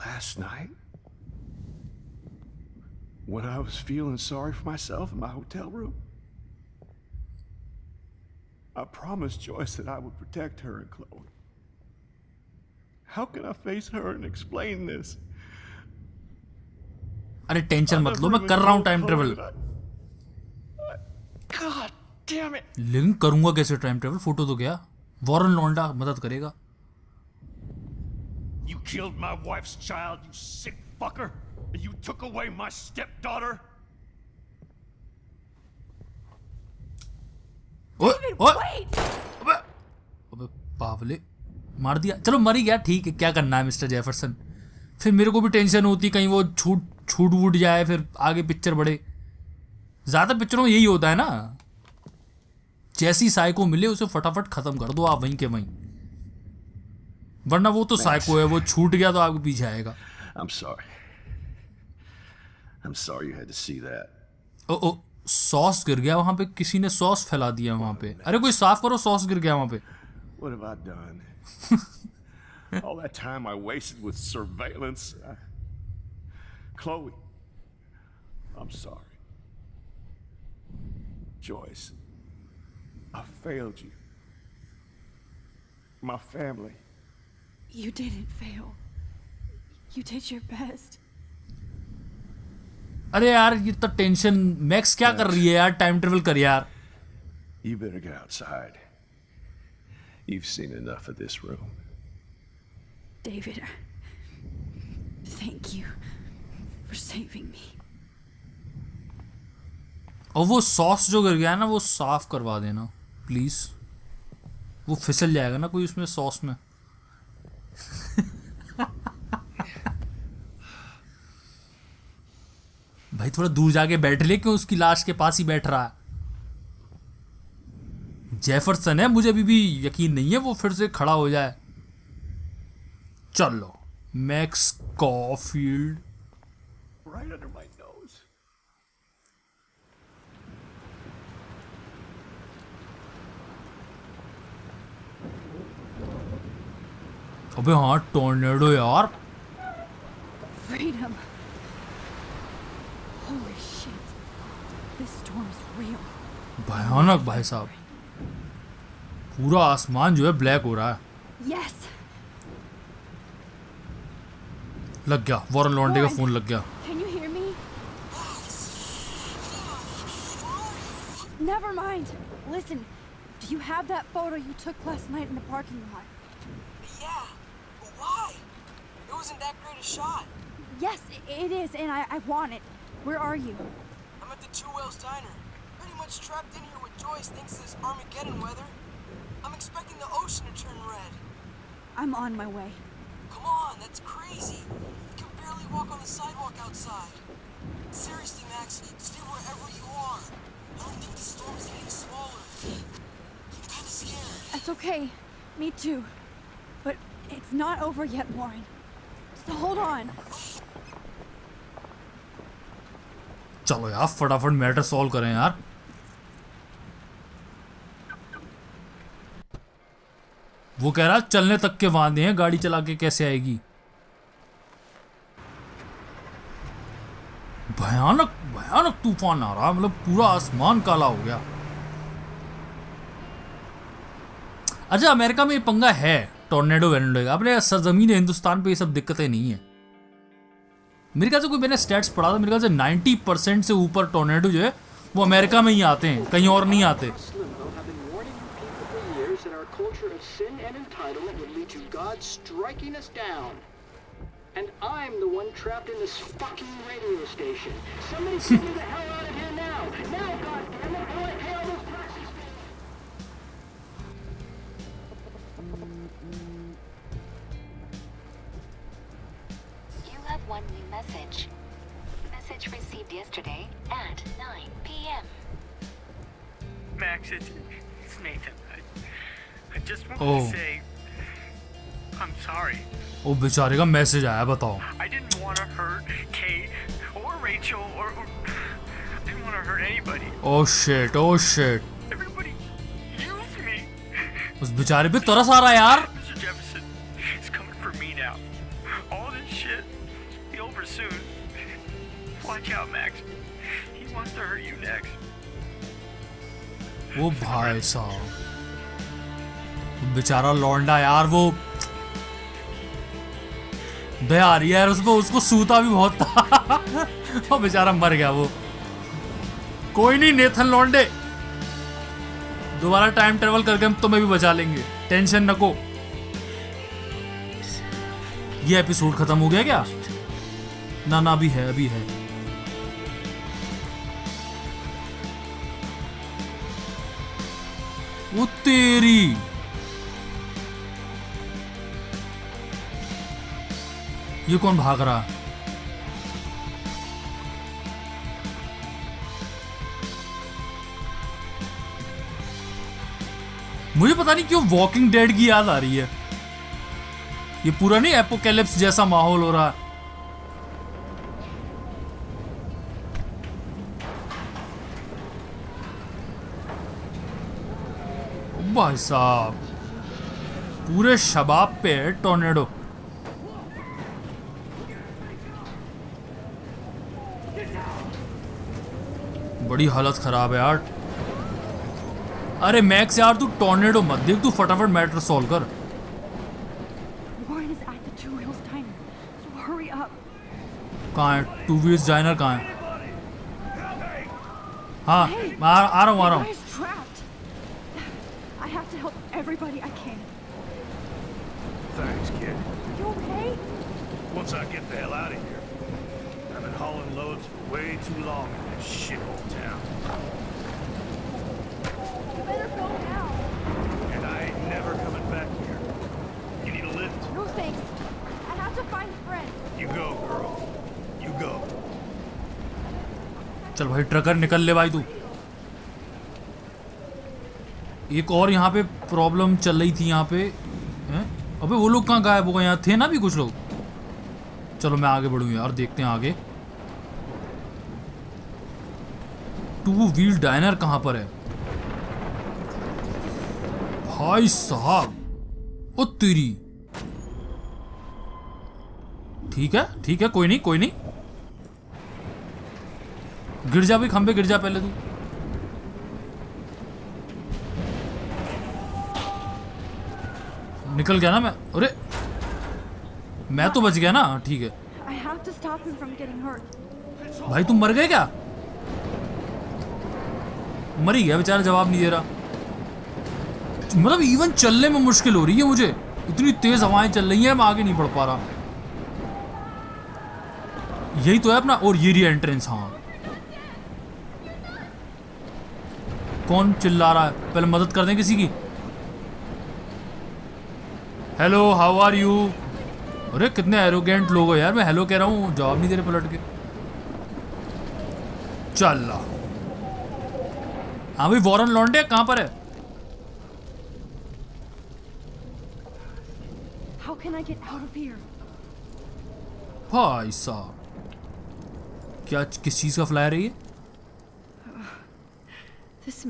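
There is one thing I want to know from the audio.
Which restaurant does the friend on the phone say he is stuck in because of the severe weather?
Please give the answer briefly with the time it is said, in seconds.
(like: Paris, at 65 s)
Two Whales Diner, at 184 s.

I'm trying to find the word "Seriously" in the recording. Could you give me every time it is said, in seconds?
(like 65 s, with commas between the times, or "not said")
197 s.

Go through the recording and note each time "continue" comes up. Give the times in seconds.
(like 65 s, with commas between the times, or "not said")
not said.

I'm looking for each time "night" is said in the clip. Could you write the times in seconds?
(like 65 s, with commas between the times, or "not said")
0 s, 175 s.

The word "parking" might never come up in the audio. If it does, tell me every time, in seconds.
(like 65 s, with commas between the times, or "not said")
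175 s.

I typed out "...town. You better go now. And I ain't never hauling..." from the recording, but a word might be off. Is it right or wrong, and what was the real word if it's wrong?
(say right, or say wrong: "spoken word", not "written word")
wrong: "coming", not "hauling".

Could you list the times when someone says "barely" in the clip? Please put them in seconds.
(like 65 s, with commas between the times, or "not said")
195 s.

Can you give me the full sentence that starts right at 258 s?
Somebody figure the hell out of here now!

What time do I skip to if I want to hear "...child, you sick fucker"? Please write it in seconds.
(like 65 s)
29 s.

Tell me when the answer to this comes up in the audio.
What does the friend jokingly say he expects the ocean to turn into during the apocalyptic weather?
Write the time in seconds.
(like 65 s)
190 s.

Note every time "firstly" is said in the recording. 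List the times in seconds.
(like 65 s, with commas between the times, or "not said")
not said.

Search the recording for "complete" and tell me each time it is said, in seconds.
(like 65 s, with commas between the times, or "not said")
not said.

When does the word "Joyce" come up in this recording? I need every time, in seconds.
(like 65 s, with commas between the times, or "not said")
9 s, 81 s, 186 s.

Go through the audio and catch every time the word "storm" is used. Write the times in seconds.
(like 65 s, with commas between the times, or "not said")
155 s, 201 s.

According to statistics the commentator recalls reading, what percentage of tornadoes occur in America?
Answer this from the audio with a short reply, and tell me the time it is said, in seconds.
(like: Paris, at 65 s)
over 90 percent, at 242 s.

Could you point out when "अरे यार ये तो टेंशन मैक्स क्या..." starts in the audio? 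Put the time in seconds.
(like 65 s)
93 s.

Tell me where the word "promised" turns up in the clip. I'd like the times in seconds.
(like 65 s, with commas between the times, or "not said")
8 s.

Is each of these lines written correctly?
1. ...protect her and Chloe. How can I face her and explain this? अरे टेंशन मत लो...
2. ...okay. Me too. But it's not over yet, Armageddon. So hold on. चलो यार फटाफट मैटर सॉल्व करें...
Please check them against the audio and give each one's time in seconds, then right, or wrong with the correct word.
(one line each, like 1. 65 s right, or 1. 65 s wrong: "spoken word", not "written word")
1. 10 s right
2. 204 s wrong: "Warren", not "Armageddon".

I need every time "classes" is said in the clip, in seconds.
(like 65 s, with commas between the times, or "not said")
not said.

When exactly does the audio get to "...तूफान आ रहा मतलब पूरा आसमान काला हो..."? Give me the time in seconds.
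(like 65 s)
229 s.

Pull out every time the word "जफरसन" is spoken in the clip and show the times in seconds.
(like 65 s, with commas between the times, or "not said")
43 s, 128 s.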